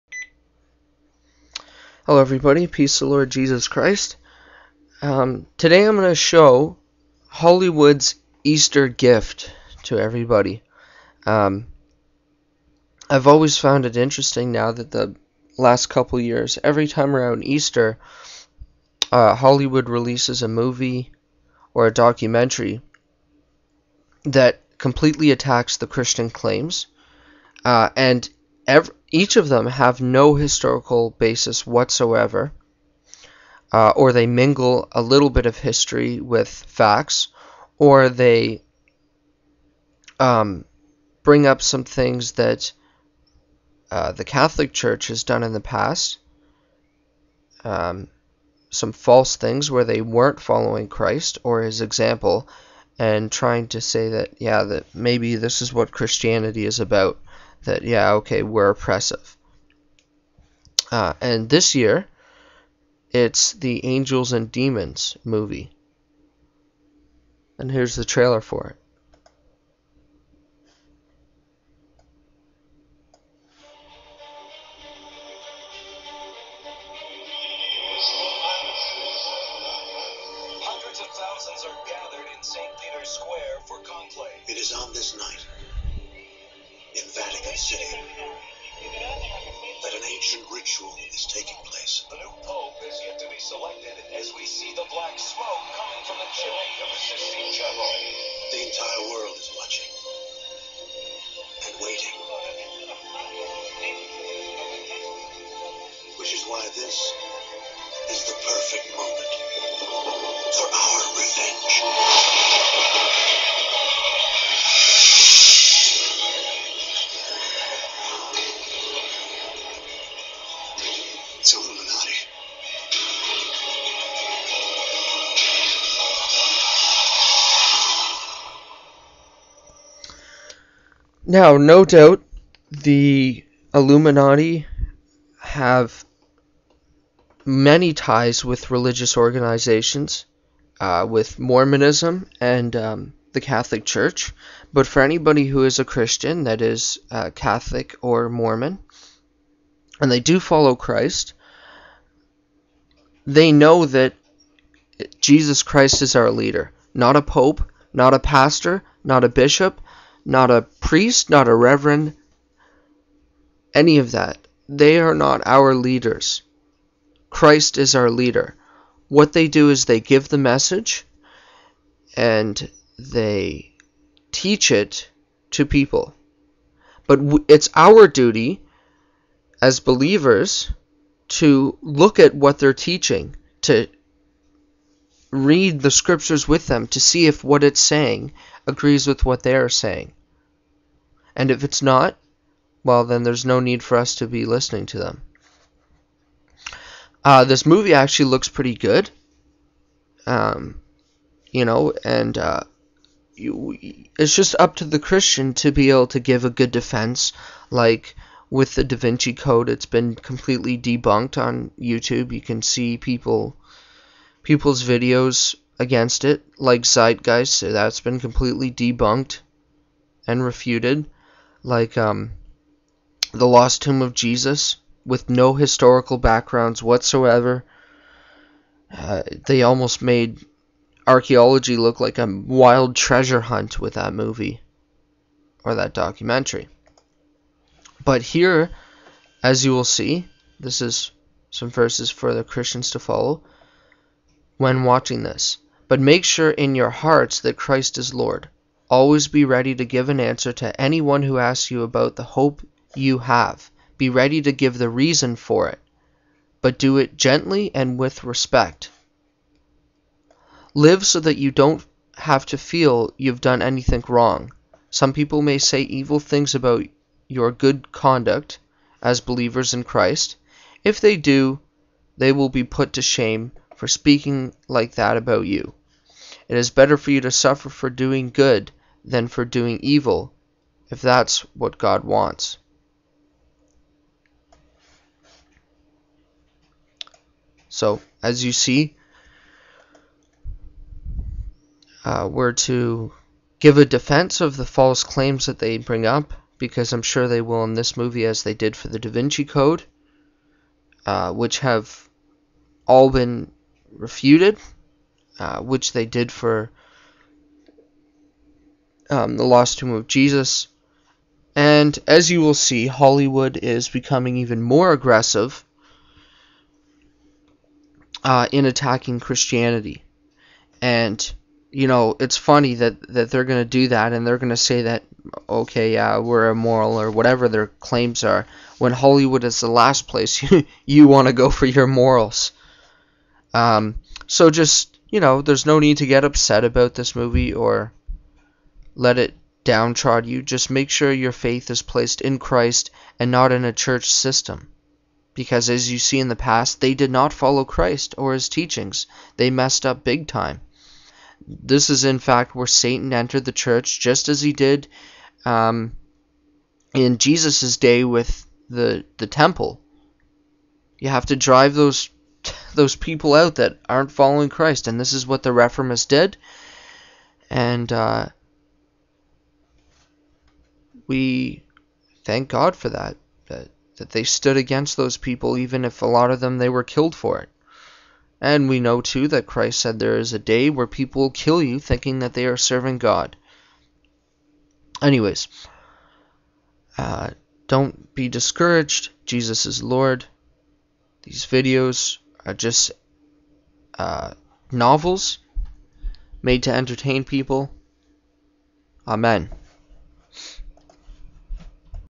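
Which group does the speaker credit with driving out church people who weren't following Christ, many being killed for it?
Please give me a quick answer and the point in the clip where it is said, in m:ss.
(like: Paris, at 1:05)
the reformists, at 6:05.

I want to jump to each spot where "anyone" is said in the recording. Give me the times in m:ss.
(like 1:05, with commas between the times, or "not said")
4:10.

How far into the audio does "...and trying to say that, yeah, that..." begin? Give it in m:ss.
0:52.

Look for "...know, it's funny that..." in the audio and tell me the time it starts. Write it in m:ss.
5:21.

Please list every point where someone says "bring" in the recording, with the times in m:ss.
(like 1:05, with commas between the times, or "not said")
0:41, 4:55.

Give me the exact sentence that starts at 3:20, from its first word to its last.
Um, you know, and uh, you, it's just up to the Christian to be able to give a good defense.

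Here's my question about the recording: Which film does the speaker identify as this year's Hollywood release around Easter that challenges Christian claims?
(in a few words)
Angels and Demons.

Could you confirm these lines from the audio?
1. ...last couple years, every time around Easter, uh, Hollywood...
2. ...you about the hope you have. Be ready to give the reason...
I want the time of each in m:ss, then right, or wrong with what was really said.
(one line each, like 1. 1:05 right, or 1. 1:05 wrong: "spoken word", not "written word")
1. 0:15 right
2. 4:11 right.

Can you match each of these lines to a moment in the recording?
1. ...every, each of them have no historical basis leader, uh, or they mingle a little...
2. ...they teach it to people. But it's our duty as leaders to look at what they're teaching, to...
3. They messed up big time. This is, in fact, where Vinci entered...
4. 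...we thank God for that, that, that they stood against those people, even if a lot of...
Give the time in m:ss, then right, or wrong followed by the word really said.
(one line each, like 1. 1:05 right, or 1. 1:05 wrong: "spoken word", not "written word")
1. 0:28 wrong: "whatsoever", not "leader"
2. 2:52 wrong: "believers", not "leaders"
3. 5:49 wrong: "Satan", not "Vinci"
4. 6:11 right.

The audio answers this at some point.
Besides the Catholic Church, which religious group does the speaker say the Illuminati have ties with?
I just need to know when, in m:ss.
2:21.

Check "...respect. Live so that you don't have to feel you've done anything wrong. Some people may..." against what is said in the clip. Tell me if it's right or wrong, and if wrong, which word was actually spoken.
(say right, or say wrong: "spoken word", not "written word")
right.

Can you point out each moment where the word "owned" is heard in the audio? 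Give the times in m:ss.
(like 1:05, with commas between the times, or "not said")
not said.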